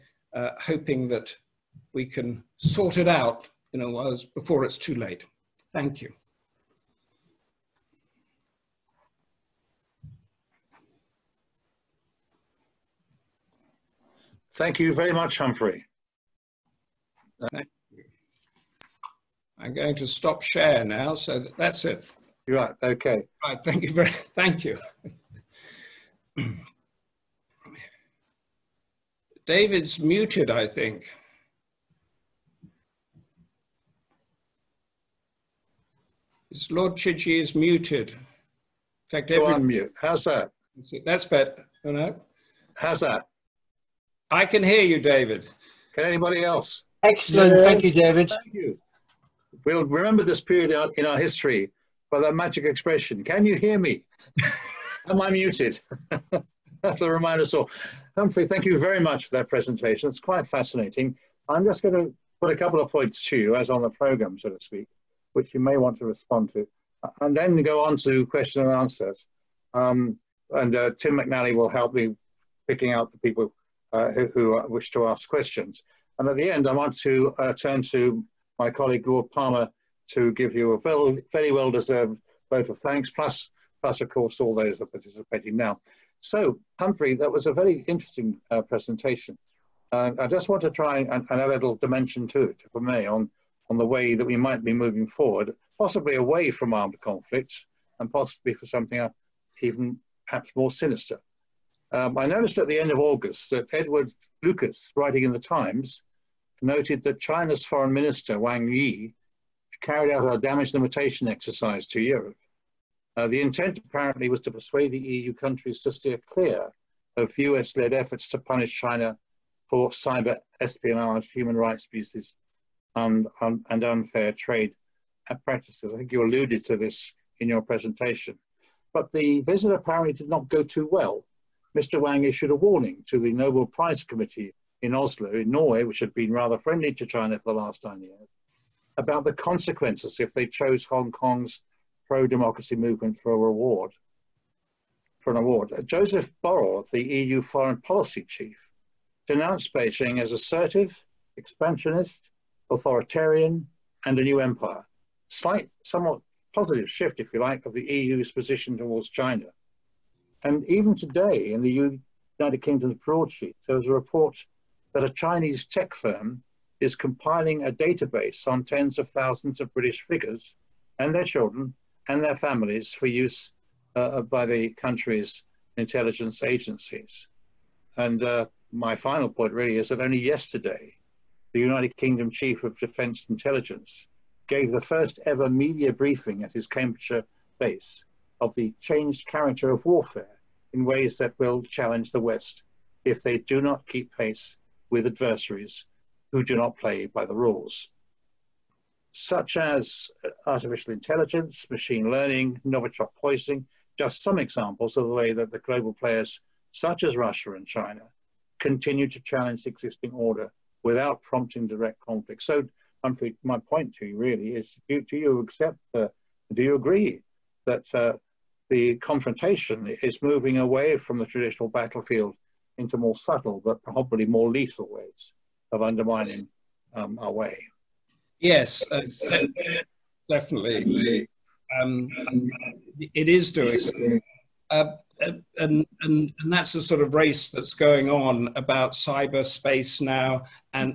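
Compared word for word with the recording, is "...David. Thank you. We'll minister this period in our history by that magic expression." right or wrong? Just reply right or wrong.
wrong.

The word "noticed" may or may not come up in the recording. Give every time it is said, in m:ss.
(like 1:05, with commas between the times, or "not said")
1:42.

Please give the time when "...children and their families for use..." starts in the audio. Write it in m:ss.
2:51.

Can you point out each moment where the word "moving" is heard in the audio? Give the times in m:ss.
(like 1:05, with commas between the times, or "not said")
1:34, 3:40.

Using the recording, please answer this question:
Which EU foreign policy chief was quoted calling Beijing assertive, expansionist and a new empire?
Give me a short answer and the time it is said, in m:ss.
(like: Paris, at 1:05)
Joseph Borrell, at 2:25.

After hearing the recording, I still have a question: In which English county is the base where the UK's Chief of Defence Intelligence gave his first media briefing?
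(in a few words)
Cambridgeshire.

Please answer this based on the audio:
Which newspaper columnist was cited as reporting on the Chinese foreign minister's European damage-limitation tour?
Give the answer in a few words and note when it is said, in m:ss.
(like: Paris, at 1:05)
Edward Lucas, at 1:43.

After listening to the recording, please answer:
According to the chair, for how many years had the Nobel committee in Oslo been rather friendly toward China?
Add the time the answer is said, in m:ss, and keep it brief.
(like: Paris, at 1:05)
9, at 2:17.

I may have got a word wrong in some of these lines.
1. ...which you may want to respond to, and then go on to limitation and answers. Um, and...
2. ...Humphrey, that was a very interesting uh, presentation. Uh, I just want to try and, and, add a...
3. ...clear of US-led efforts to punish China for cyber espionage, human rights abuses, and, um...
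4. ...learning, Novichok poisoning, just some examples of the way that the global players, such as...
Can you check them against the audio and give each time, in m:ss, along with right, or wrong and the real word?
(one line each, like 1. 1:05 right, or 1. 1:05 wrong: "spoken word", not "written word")
1. 1:05 wrong: "question", not "limitation"
2. 1:26 right
3. 1:56 right
4. 3:22 right.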